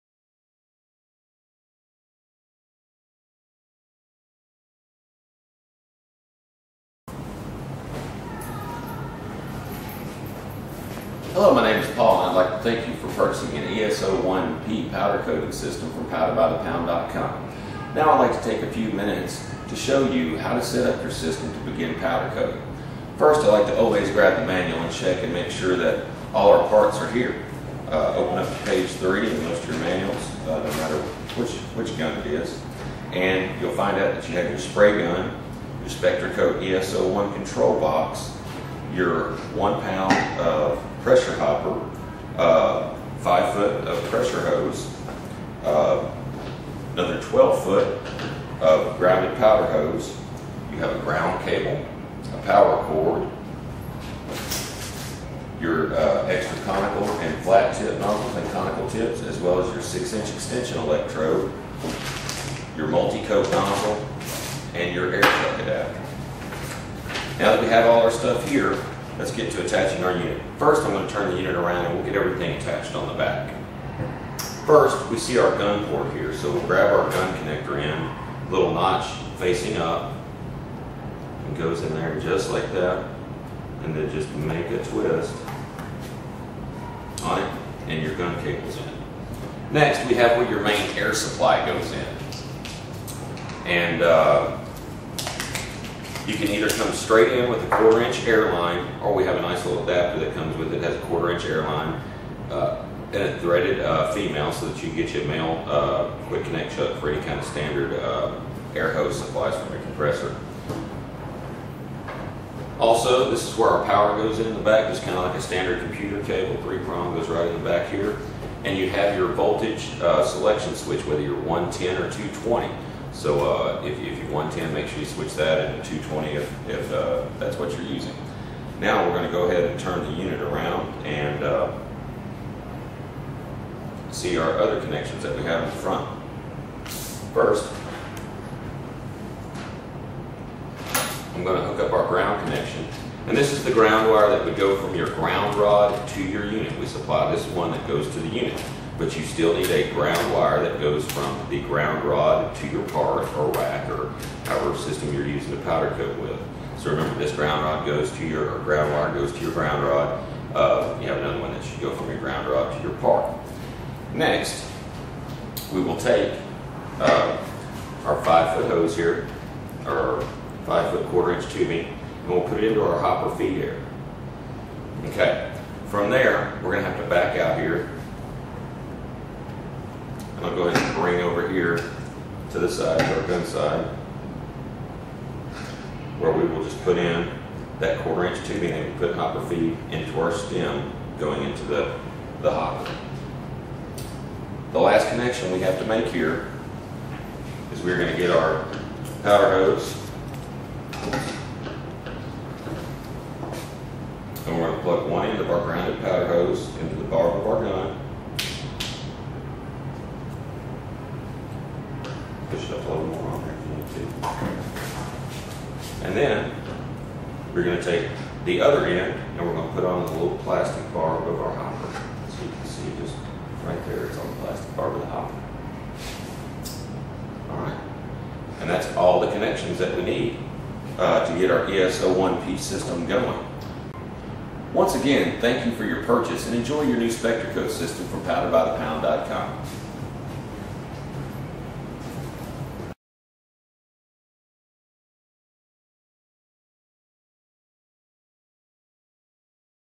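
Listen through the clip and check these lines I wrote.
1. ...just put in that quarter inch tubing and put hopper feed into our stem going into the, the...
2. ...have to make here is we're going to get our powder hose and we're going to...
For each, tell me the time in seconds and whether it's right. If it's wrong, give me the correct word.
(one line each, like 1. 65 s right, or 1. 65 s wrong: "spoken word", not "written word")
1. 186 s right
2. 195 s right.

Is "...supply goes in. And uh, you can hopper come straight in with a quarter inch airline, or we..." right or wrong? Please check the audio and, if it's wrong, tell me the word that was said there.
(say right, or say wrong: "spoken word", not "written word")
wrong: "either", not "hopper".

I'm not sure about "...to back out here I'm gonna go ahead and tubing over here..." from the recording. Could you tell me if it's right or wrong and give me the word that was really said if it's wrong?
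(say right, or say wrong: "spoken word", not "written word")
wrong: "bring", not "tubing".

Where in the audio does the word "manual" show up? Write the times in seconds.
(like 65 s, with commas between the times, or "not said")
24 s, 29 s.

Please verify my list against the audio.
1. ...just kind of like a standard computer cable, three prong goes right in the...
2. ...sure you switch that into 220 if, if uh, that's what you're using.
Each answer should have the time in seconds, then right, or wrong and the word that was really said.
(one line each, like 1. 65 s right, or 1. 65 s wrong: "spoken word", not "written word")
1. 114 s right
2. 124 s right.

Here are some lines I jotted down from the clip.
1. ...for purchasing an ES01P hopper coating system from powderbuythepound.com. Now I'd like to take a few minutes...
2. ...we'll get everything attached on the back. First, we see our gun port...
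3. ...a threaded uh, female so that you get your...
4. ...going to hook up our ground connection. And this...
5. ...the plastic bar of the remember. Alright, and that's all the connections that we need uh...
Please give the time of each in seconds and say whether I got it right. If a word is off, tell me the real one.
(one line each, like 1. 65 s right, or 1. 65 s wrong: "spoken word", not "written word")
1. 12 s wrong: "powder", not "hopper"
2. 71 s right
3. 103 s right
4. 141 s right
5. 224 s wrong: "hopper", not "remember".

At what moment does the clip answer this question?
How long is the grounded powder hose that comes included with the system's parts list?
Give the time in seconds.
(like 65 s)
47 s.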